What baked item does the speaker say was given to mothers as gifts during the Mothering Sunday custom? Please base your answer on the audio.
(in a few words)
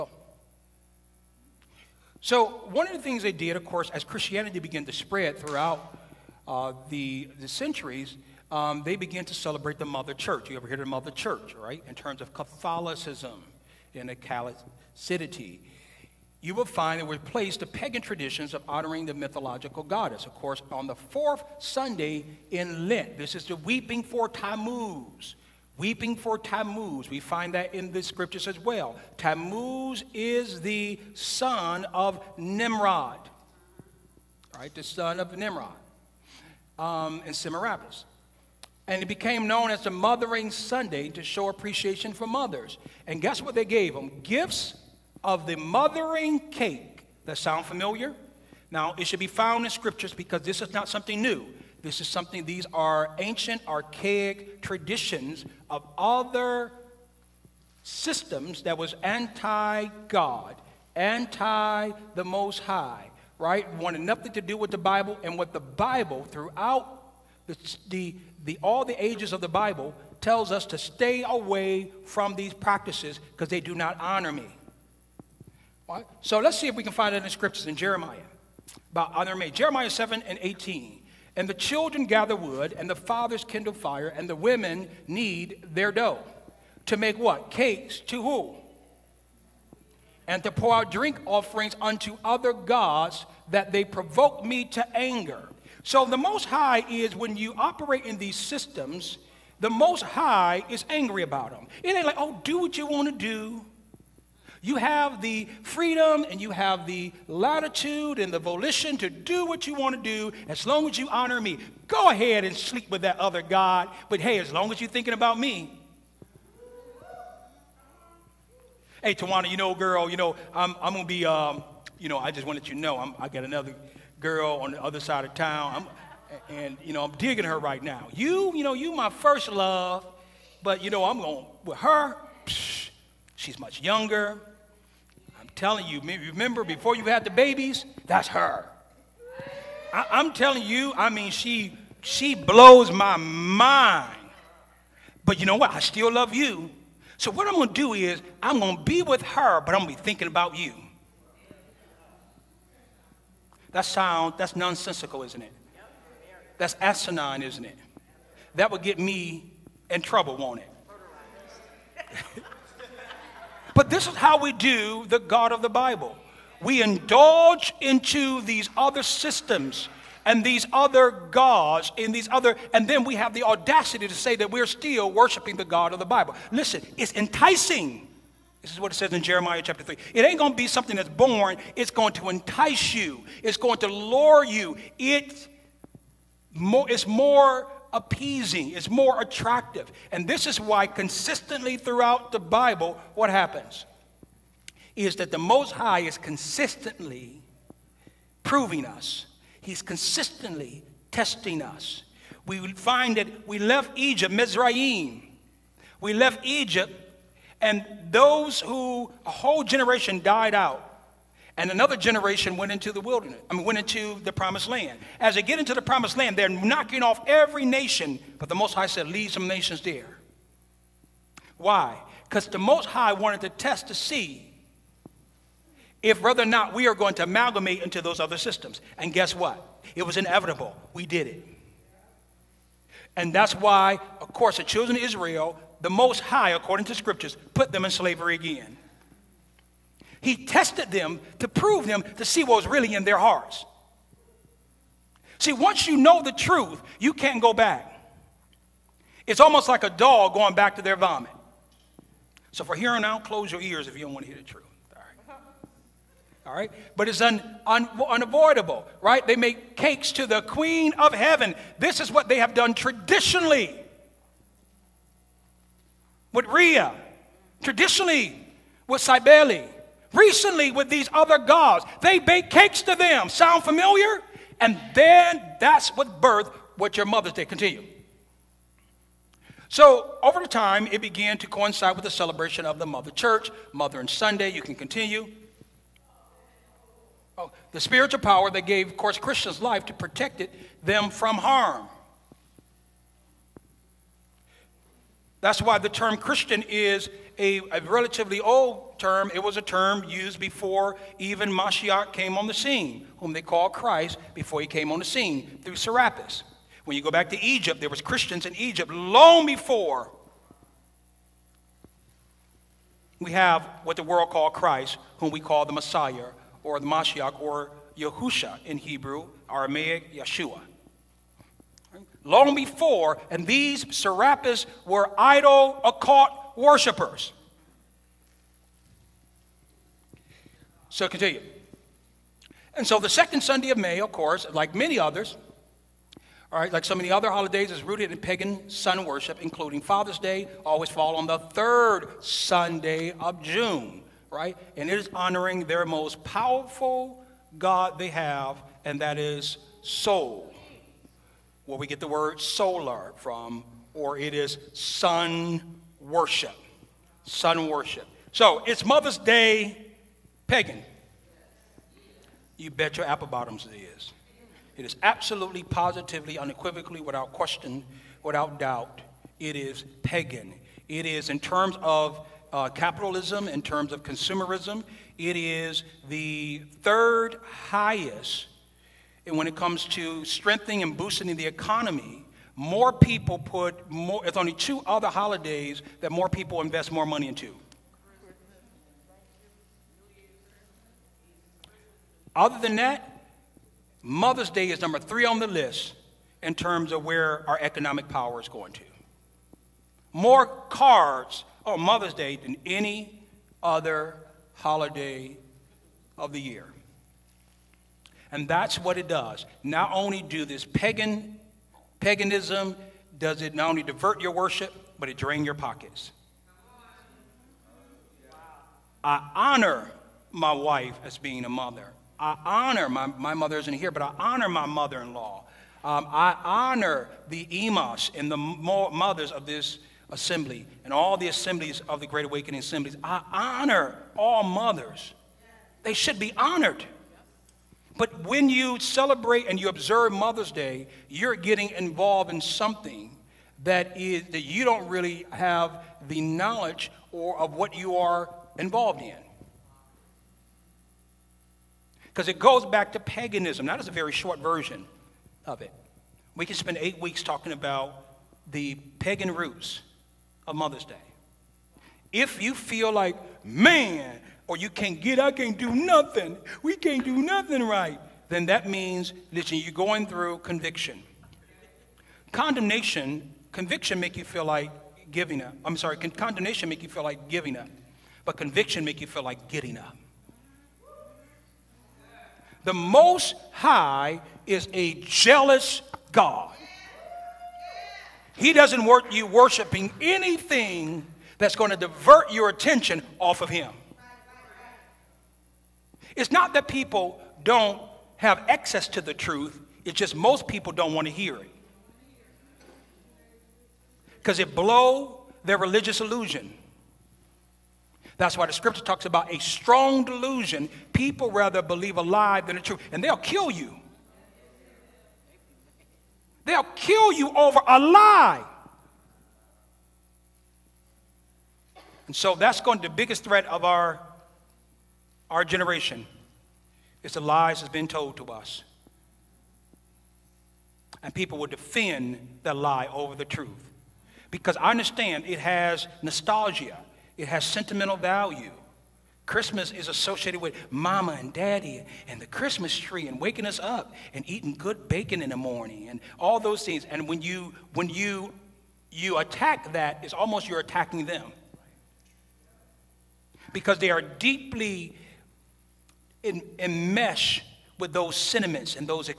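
Mothering cake.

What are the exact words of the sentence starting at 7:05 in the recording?
Um, I honor the emas and the mothers of this assembly and all the assemblies of the Great Awakening assemblies.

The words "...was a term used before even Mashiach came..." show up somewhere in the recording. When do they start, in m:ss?
4:59.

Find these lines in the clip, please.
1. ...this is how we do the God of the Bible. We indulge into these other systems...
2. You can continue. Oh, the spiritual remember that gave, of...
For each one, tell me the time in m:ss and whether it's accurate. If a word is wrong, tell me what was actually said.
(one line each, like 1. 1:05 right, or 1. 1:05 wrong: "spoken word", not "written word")
1. 2:43 right
2. 4:44 wrong: "power", not "remember".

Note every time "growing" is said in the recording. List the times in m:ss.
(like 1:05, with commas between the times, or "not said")
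not said.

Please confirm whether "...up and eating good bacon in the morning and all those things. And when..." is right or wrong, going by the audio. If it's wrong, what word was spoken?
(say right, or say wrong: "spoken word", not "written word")
right.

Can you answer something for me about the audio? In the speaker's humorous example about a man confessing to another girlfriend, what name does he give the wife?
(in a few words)
Tawana.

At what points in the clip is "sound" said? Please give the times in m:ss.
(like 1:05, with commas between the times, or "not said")
0:47, 2:33, 4:33.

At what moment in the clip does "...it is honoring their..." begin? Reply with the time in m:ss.
5:44.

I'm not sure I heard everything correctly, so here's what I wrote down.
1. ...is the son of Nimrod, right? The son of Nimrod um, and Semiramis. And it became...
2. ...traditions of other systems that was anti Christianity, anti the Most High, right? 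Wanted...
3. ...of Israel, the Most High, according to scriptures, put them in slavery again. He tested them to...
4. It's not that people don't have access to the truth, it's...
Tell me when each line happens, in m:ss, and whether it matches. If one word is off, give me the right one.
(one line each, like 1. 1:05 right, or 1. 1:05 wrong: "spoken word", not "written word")
1. 0:30 right
2. 0:54 wrong: "God", not "Christianity"
3. 3:54 right
4. 8:16 right.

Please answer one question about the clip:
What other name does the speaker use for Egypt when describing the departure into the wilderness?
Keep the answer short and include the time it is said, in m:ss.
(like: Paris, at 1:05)
Mizraim, at 3:24.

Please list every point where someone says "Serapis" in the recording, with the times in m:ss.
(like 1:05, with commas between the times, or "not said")
5:05, 5:23.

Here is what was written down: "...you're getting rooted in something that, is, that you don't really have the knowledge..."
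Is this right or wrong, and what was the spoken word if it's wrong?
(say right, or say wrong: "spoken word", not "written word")
wrong: "involved", not "rooted".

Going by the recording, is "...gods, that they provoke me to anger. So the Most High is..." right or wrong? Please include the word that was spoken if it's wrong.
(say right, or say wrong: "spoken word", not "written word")
right.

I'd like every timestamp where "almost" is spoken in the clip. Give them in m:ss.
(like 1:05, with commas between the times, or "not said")
4:09, 9:10.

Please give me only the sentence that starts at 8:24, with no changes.
Because it blow their religious illusion.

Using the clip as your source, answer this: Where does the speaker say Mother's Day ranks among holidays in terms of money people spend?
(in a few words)
Number three.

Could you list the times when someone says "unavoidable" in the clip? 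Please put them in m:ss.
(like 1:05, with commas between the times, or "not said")
4:18.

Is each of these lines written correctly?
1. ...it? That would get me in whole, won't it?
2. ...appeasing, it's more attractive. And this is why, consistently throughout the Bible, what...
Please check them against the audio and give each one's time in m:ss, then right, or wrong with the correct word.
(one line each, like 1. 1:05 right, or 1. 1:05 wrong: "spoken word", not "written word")
1. 2:37 wrong: "trouble", not "whole"
2. 3:07 right.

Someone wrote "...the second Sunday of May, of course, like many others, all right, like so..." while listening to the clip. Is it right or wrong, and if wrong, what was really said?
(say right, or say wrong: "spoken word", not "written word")
right.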